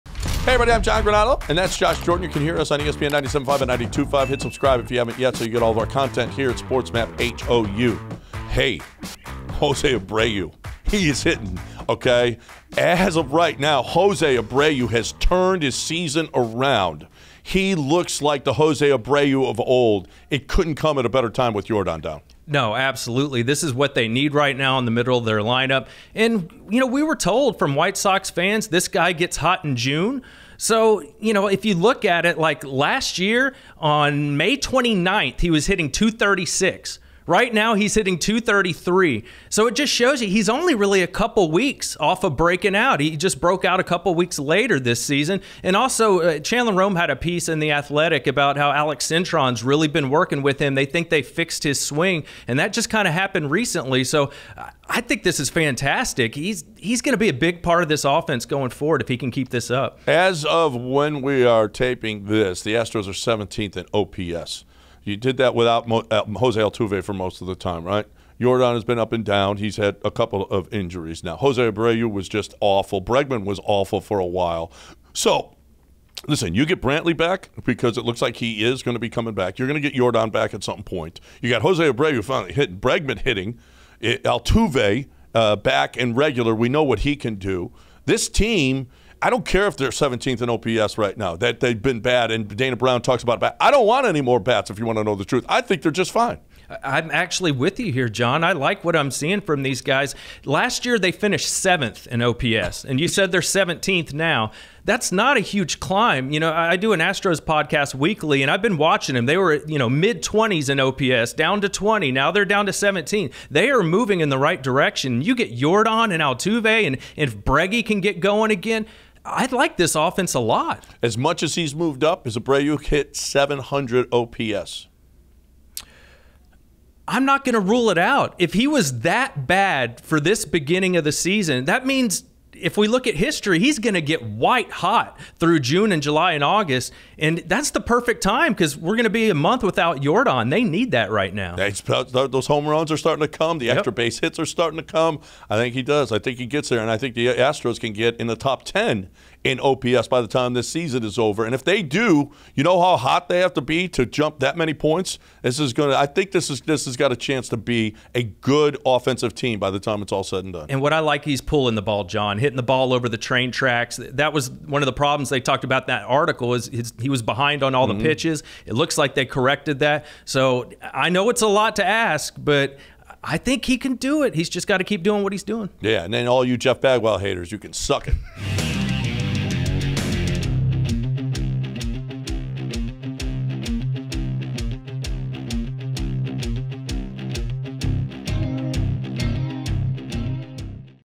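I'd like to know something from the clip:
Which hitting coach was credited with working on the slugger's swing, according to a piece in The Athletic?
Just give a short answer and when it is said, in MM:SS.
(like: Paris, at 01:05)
Alex Cintron, at 00:48.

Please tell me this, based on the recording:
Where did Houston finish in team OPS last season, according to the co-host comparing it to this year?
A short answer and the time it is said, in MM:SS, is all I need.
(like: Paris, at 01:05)
7th, at 01:41.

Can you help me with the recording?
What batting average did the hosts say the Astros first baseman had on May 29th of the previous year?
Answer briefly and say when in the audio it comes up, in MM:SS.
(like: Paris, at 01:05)
.236, at 00:35.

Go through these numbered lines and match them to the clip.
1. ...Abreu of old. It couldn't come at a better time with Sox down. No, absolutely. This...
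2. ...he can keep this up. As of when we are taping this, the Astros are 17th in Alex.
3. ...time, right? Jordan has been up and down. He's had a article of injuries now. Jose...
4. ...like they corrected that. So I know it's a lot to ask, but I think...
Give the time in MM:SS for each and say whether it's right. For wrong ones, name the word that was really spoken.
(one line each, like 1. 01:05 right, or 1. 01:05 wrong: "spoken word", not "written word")
1. 00:18 wrong: "Jordan", not "Sox"
2. 00:59 wrong: "OPS", not "Alex"
3. 01:07 wrong: "couple", not "article"
4. 02:48 right.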